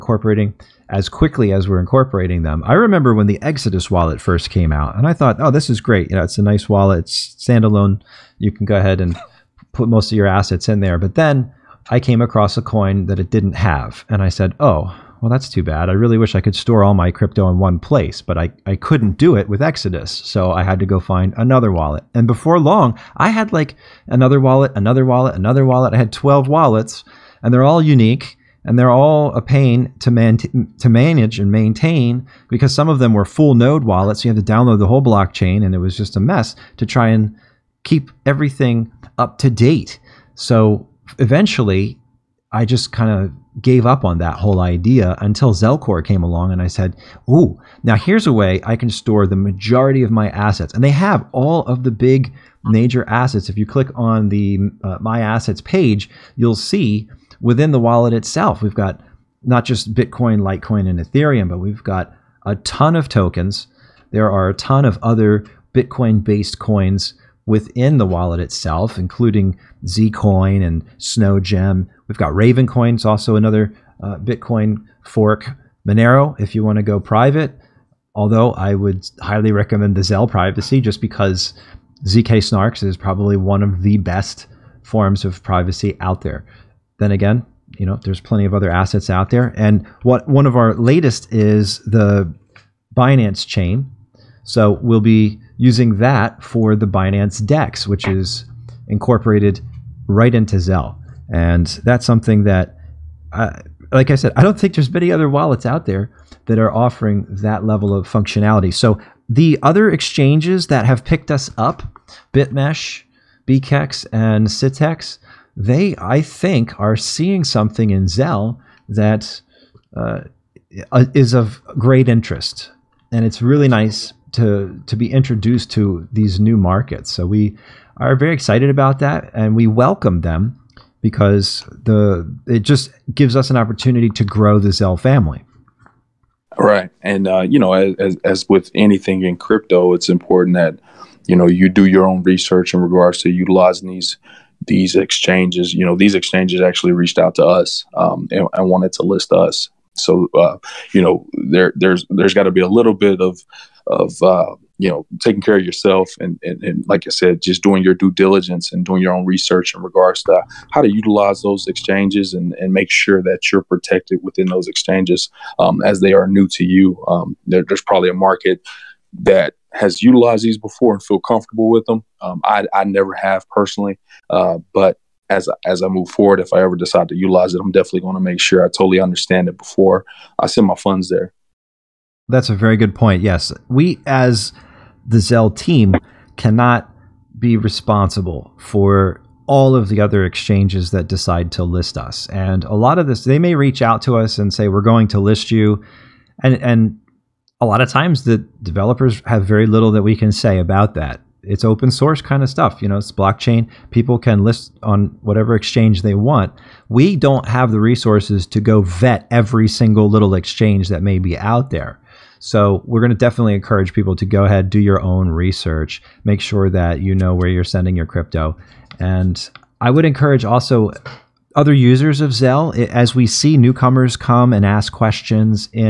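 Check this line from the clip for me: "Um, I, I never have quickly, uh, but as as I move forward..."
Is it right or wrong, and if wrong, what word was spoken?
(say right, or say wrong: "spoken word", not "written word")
wrong: "personally", not "quickly".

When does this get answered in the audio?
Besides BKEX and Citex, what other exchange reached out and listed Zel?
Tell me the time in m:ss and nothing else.
1:52.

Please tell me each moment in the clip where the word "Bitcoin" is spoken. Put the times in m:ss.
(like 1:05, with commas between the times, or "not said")
0:59, 1:05, 1:14.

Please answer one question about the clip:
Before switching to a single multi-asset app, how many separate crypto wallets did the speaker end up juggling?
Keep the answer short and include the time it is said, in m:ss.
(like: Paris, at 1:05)
12, at 0:26.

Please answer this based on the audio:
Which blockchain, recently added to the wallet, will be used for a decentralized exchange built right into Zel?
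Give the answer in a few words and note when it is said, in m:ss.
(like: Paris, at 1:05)
Binance chain, at 1:32.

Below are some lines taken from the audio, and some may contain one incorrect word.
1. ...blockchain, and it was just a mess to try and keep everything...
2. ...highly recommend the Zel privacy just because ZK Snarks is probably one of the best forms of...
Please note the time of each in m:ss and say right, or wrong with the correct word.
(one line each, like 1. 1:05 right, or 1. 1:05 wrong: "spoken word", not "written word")
1. 0:35 right
2. 1:19 right.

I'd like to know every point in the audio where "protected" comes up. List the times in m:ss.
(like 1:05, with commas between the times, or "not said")
2:43.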